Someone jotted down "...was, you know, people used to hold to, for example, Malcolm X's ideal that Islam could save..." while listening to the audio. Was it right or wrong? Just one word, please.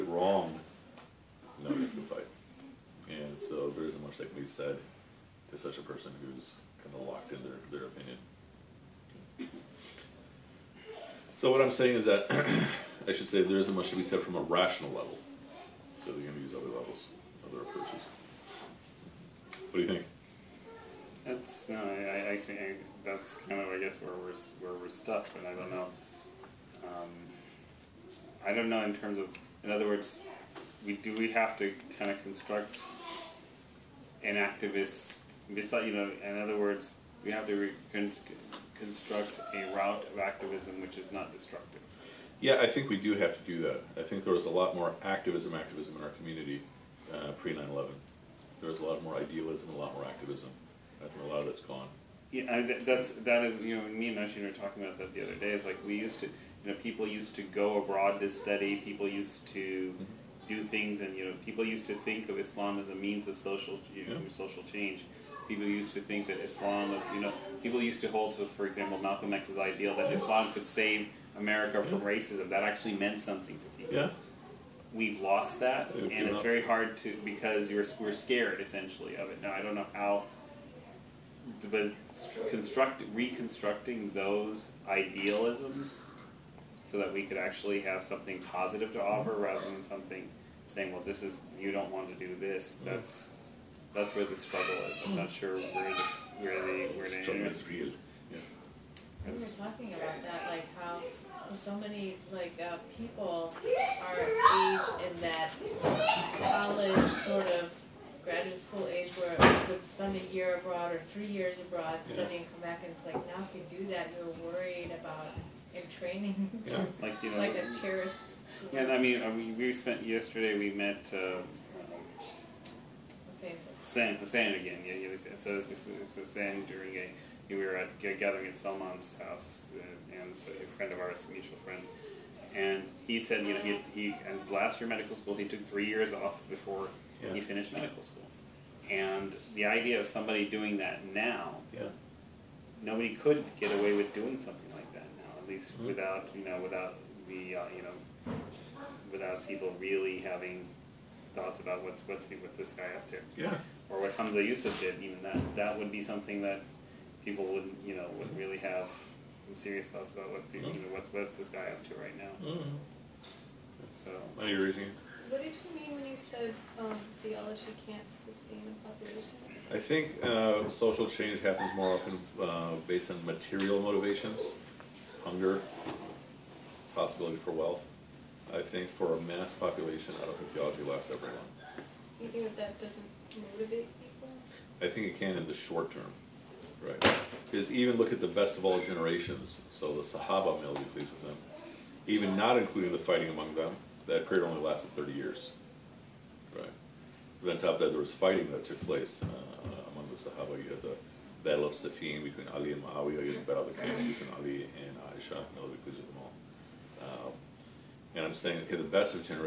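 right.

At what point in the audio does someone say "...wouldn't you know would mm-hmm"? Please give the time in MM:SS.
02:37.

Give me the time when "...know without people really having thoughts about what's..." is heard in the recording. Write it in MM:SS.
02:27.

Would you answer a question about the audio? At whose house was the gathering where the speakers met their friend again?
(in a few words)
Salman.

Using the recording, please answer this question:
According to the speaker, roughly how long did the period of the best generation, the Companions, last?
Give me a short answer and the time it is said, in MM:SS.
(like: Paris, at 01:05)
30 years, at 03:14.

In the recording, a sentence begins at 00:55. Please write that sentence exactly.
It's like we used to, you know, people used to go abroad to study.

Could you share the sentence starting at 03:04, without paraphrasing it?
I think it can in the short term.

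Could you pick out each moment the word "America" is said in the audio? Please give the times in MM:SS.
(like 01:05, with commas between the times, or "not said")
01:11.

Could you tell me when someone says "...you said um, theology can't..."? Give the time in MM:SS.
02:46.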